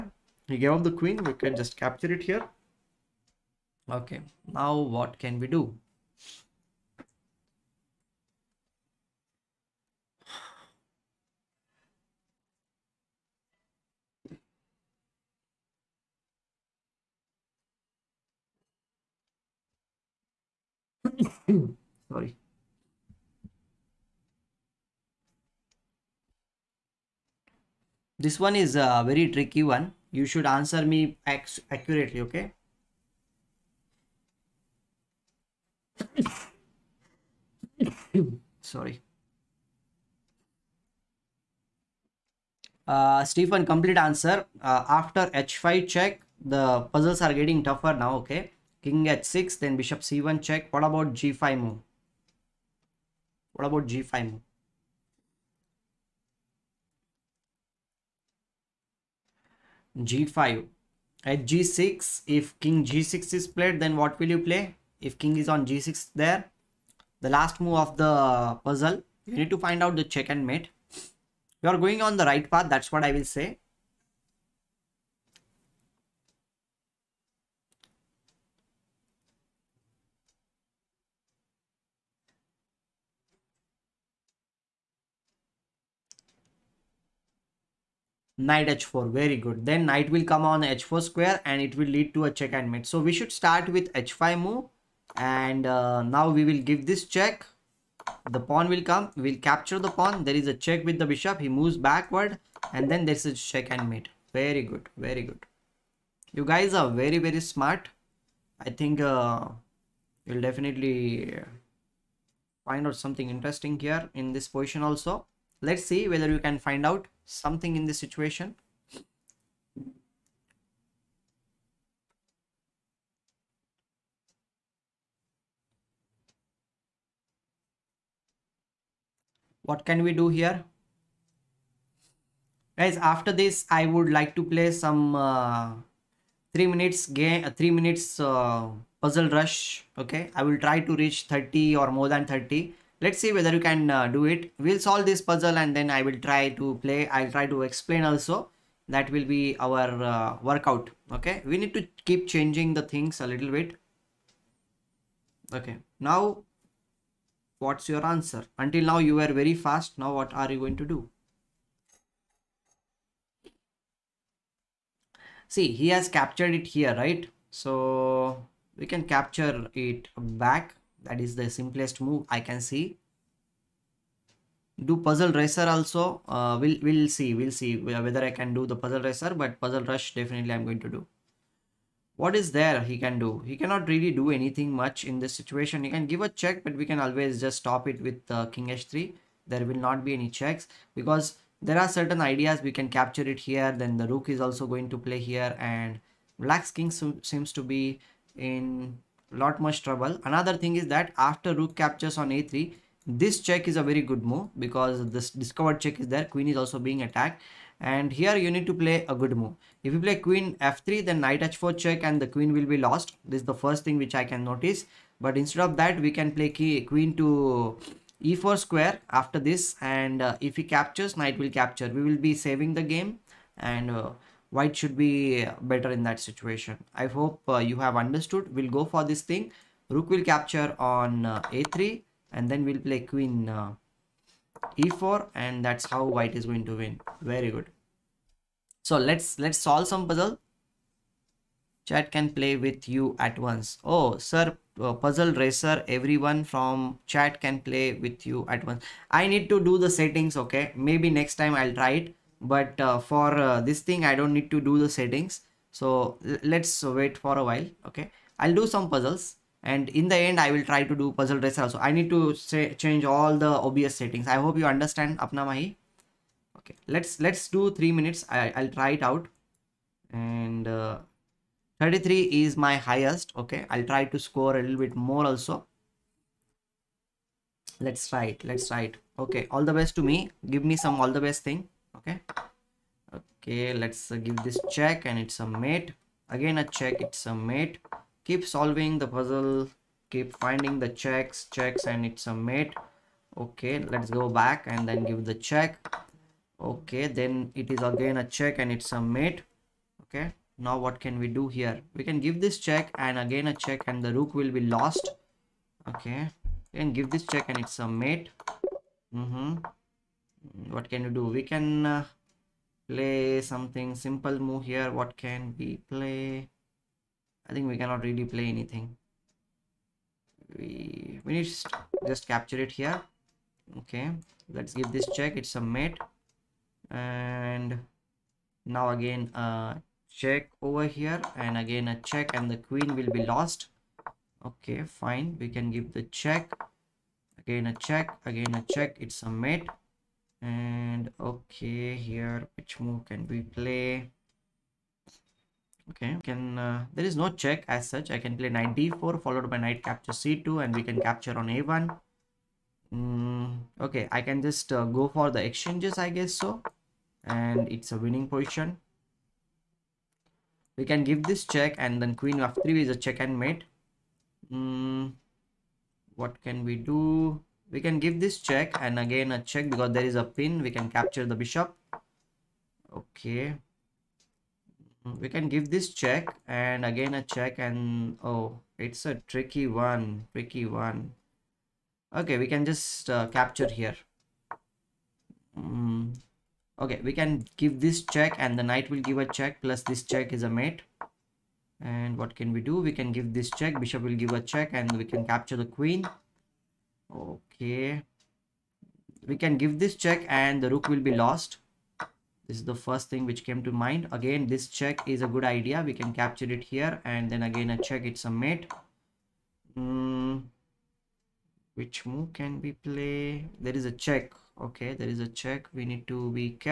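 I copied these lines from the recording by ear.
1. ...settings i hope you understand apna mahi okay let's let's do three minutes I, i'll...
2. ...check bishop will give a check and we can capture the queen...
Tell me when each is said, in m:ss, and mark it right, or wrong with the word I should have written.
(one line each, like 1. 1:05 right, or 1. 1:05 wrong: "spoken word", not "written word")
1. 4:23 right
2. 6:33 right.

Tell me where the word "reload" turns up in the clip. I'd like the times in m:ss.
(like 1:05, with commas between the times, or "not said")
not said.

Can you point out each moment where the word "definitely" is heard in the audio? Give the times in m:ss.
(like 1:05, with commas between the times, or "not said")
1:50, 3:00.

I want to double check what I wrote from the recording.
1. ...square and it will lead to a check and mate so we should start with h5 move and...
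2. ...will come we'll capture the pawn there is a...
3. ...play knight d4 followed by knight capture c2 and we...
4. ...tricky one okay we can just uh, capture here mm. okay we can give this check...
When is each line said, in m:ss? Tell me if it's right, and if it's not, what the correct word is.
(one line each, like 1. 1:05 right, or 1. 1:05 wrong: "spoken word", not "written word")
1. 1:31 right
2. 1:38 right
3. 5:48 right
4. 6:20 right.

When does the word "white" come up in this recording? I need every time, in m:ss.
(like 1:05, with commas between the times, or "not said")
3:44, 3:56.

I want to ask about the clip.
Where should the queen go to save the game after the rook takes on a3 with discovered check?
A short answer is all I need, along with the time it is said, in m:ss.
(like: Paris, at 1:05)
e4, at 3:36.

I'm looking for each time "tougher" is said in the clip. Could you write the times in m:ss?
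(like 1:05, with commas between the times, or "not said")
0:47.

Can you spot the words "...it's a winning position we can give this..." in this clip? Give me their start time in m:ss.
5:57.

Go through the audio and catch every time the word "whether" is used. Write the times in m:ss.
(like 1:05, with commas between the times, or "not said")
1:56, 2:23, 2:57.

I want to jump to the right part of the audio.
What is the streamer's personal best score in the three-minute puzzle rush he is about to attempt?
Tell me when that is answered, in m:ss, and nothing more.
4:31.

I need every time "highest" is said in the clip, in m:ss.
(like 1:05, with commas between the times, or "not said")
4:32.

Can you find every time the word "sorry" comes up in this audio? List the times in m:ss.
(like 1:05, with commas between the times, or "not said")
0:22, 0:38.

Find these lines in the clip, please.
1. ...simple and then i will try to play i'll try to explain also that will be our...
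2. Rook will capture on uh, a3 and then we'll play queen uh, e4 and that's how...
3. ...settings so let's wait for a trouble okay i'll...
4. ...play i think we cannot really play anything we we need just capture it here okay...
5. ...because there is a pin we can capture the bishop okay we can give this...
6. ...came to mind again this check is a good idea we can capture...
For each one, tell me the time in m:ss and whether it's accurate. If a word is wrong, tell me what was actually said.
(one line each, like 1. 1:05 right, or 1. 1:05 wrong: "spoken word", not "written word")
1. 2:25 wrong: "puzzle", not "simple"
2. 3:49 right
3. 4:14 wrong: "while", not "trouble"
4. 5:15 right
5. 6:09 right
6. 6:43 right.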